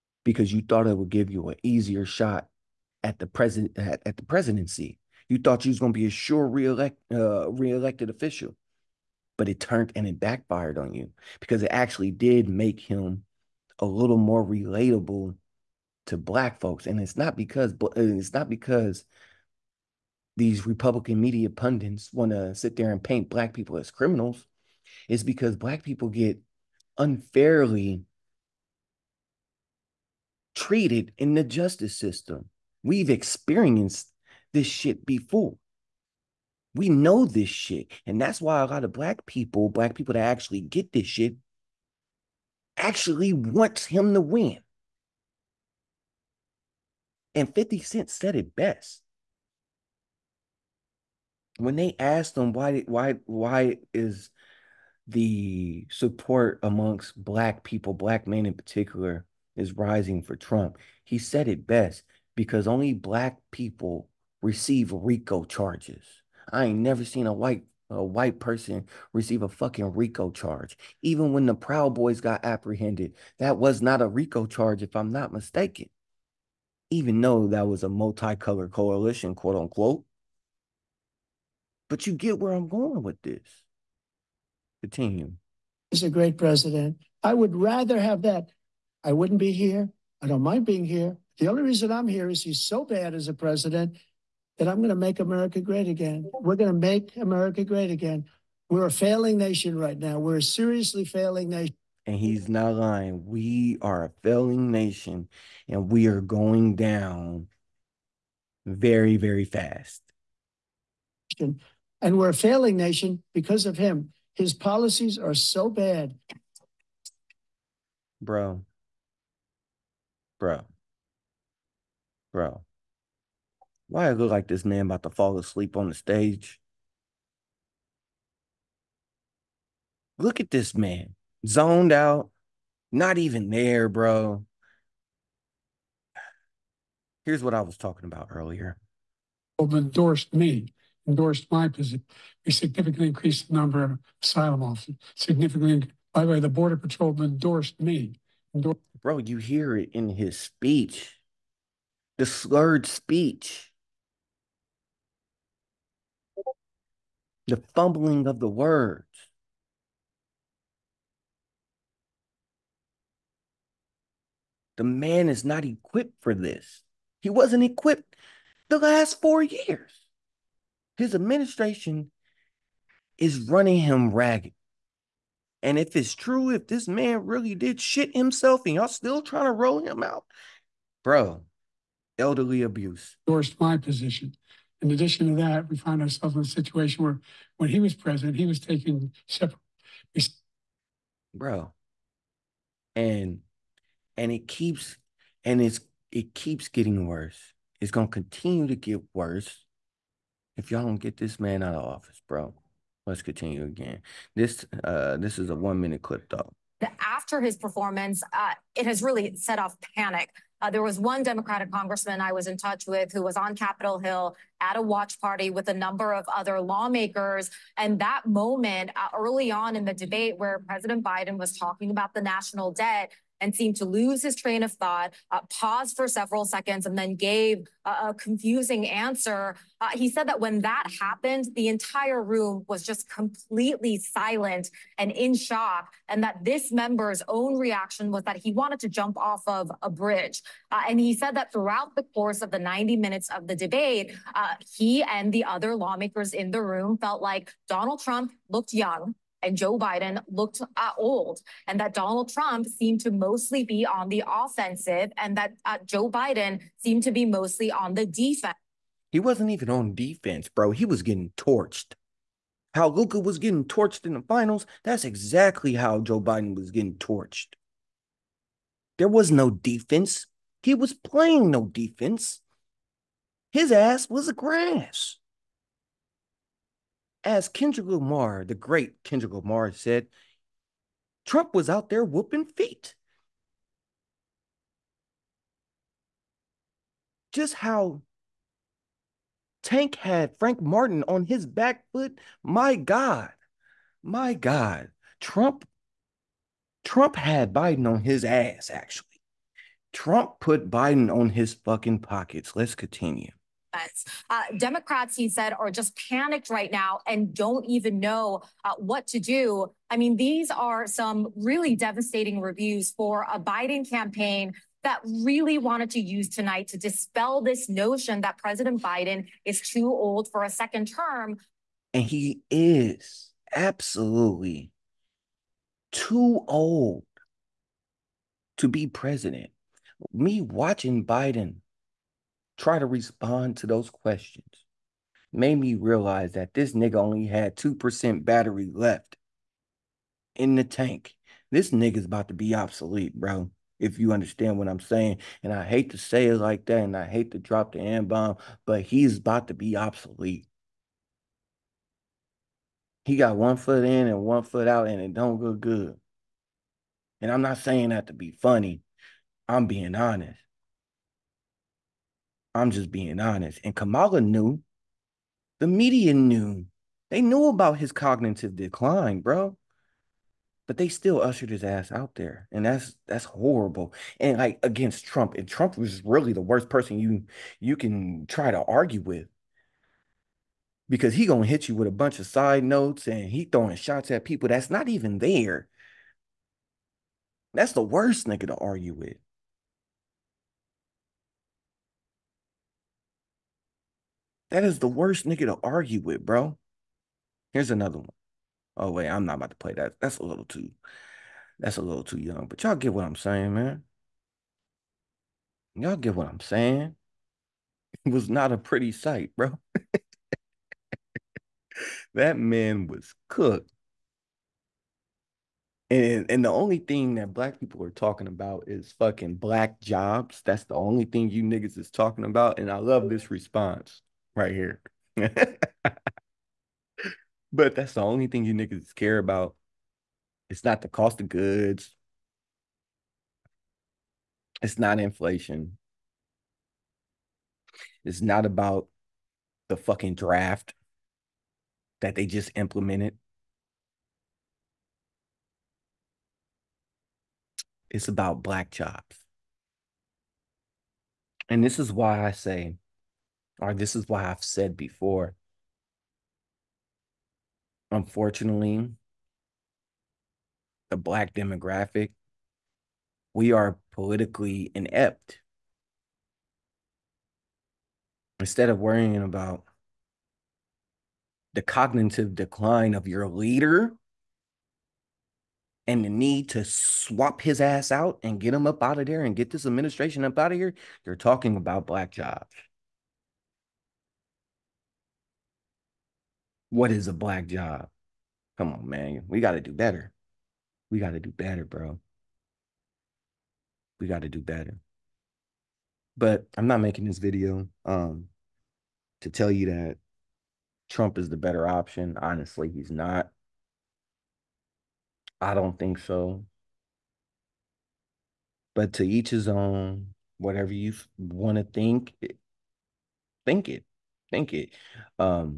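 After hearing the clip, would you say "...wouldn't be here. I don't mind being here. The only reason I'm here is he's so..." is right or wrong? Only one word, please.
right.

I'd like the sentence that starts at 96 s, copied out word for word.
We're going to make America great again.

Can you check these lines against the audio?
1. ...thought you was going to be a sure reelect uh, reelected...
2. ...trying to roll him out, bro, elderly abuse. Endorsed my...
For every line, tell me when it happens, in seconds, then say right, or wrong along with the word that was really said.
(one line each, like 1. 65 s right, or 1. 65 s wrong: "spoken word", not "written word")
1. 5 s right
2. 179 s right.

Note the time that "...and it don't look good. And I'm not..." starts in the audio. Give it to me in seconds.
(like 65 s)
354 s.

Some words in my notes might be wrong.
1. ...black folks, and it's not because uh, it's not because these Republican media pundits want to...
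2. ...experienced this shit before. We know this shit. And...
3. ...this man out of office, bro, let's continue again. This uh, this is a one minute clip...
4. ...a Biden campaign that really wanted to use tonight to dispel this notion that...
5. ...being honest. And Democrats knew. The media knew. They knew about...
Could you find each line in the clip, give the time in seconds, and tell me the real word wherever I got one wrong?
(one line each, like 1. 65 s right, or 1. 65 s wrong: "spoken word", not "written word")
1. 16 s right
2. 33 s right
3. 201 s right
4. 313 s right
5. 362 s wrong: "Kamala", not "Democrats".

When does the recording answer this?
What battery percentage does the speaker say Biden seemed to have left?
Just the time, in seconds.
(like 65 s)
337 s.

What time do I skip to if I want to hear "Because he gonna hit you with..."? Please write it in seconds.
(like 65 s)
380 s.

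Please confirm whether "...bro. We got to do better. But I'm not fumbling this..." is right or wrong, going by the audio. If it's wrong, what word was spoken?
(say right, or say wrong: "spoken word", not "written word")
wrong: "making", not "fumbling".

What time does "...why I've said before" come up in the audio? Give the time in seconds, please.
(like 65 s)
454 s.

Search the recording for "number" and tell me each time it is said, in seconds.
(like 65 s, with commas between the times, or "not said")
143 s, 215 s.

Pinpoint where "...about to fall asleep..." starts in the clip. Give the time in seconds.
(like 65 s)
124 s.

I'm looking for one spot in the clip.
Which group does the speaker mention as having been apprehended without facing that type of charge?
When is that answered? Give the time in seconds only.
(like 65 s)
71 s.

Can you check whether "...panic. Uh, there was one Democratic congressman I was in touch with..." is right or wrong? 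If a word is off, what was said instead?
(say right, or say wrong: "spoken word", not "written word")
right.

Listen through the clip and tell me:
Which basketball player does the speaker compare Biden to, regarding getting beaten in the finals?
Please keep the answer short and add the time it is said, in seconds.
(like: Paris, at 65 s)
Luka, at 262 s.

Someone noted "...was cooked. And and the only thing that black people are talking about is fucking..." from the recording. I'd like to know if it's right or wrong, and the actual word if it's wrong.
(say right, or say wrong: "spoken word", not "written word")
right.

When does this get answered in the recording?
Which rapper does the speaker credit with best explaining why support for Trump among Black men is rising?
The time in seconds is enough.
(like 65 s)
47 s.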